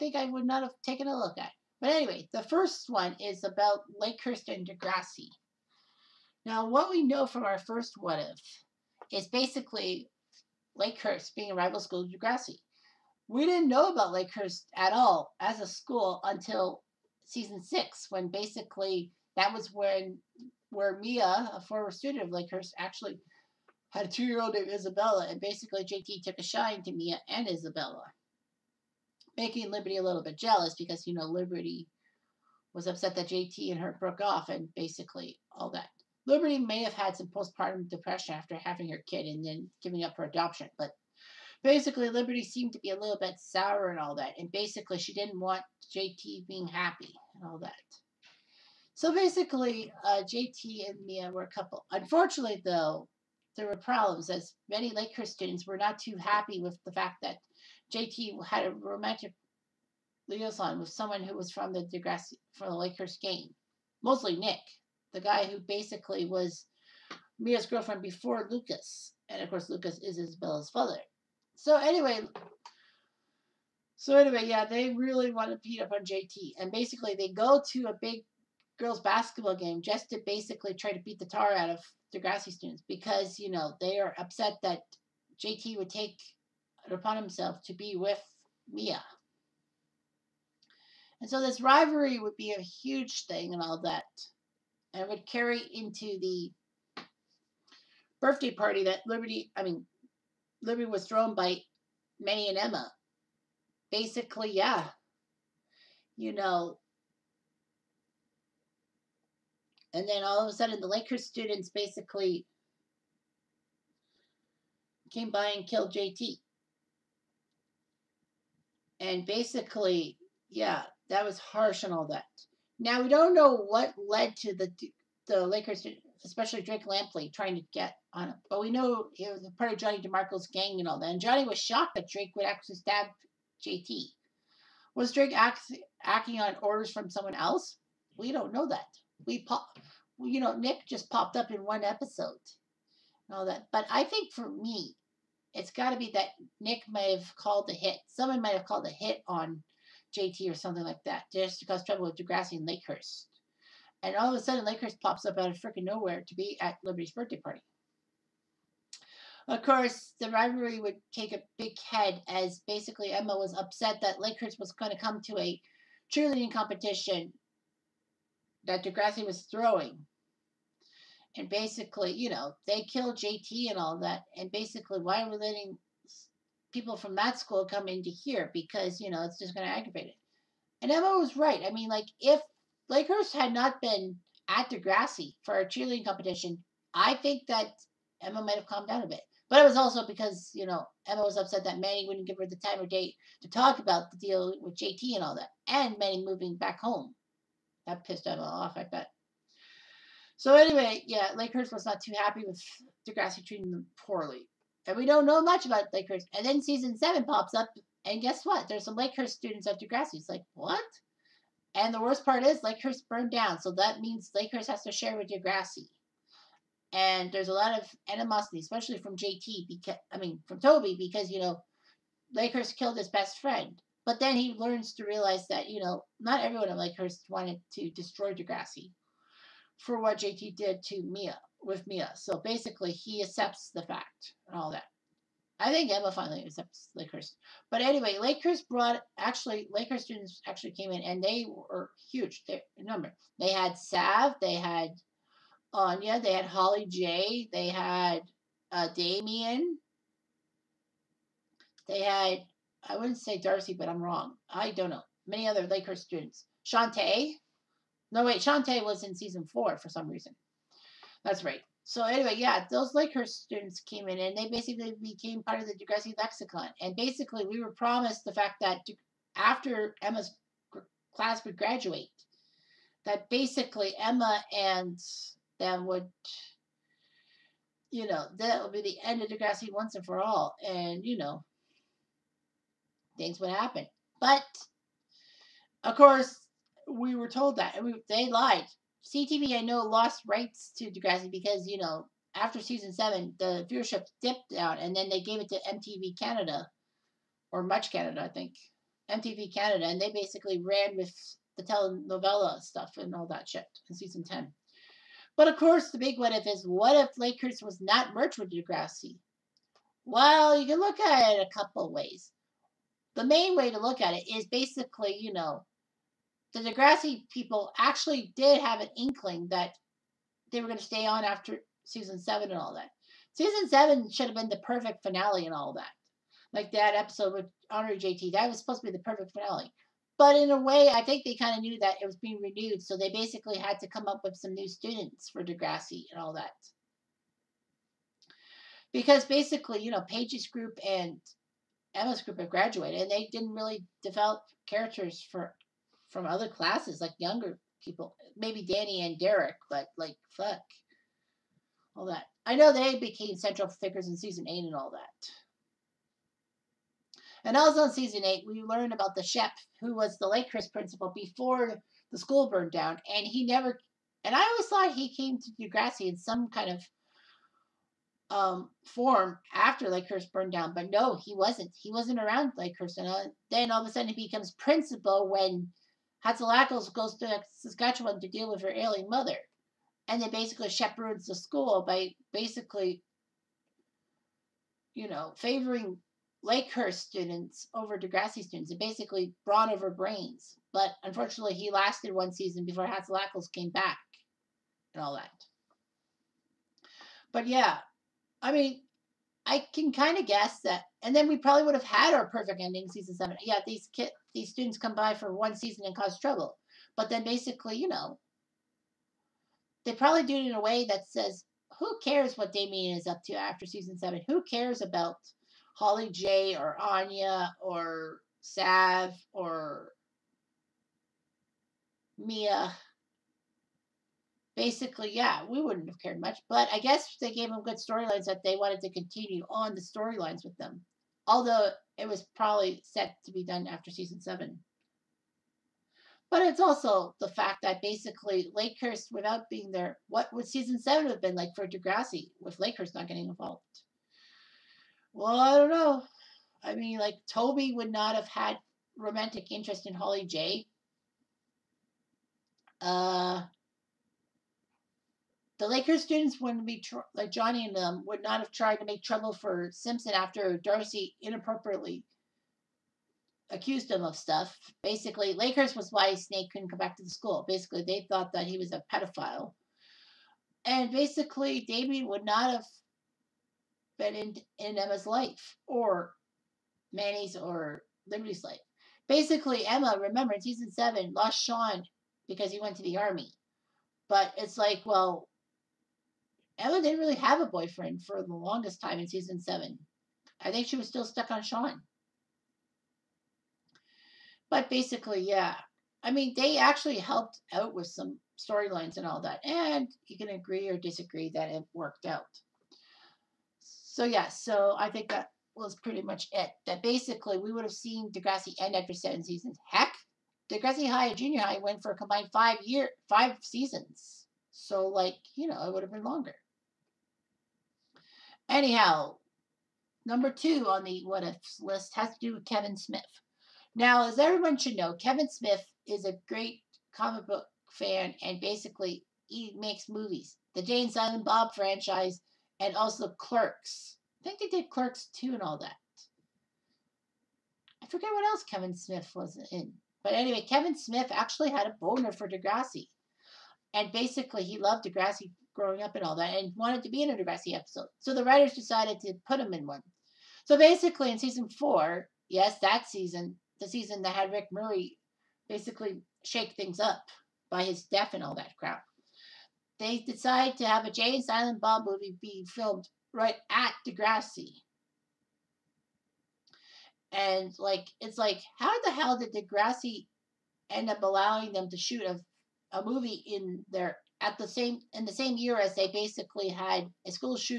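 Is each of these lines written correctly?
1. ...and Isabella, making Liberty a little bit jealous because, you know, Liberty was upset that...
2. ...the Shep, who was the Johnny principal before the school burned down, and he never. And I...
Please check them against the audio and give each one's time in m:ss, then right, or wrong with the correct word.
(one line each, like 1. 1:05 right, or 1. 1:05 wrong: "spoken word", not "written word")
1. 0:27 right
2. 5:59 wrong: "Chris", not "Johnny".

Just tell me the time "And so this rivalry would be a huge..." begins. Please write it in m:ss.
1:31.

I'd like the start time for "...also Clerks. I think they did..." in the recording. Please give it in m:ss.
8:52.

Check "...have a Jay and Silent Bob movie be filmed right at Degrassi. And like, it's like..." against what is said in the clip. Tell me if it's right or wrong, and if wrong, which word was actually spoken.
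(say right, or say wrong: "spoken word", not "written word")
right.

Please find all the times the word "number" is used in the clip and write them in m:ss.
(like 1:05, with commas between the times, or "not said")
4:02, 8:40.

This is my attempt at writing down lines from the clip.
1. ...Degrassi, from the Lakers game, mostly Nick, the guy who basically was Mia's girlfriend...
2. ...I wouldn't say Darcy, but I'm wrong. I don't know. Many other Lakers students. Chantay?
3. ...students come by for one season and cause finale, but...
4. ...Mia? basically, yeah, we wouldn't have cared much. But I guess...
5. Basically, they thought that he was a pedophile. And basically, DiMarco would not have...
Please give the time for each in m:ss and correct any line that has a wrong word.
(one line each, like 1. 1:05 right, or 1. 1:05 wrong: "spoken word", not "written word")
1. 1:01 right
2. 4:12 right
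3. 6:44 wrong: "trouble", not "finale"
4. 7:02 right
5. 7:47 wrong: "Damien", not "DiMarco".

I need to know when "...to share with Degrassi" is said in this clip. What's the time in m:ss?
3:34.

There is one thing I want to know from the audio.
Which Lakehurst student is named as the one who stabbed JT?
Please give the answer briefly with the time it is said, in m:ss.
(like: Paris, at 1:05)
Drake Lempkey, at 2:06.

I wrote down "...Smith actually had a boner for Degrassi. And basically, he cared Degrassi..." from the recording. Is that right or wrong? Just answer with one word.
wrong.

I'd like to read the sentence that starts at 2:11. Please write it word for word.
And Johnny was shocked that Drake would actually stab JT.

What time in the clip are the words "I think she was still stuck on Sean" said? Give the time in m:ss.
8:10.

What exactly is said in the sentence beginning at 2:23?
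But I think for me, it's got to be that Nick may have called a hit.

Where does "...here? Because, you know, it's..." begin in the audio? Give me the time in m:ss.
2:58.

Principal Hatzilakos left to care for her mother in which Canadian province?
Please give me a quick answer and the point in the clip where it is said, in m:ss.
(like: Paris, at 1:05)
Saskatchewan, at 6:17.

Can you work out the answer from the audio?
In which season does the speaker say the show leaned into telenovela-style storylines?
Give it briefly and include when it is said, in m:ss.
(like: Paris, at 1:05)
Season 10, at 5:03.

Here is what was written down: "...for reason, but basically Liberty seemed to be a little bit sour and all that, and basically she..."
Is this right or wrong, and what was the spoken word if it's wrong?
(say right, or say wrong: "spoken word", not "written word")
wrong: "adoption", not "reason".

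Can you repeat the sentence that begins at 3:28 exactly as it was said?
There's some Lakehurst students at Degrassi.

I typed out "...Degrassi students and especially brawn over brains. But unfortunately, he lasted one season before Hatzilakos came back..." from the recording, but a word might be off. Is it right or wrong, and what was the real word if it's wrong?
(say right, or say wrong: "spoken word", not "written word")
wrong: "basically", not "especially".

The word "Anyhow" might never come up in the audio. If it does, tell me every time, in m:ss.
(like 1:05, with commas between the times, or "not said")
8:38.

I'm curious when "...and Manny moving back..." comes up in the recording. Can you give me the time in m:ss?
3:15.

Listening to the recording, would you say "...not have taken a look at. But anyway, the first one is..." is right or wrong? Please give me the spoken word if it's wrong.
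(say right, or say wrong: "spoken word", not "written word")
right.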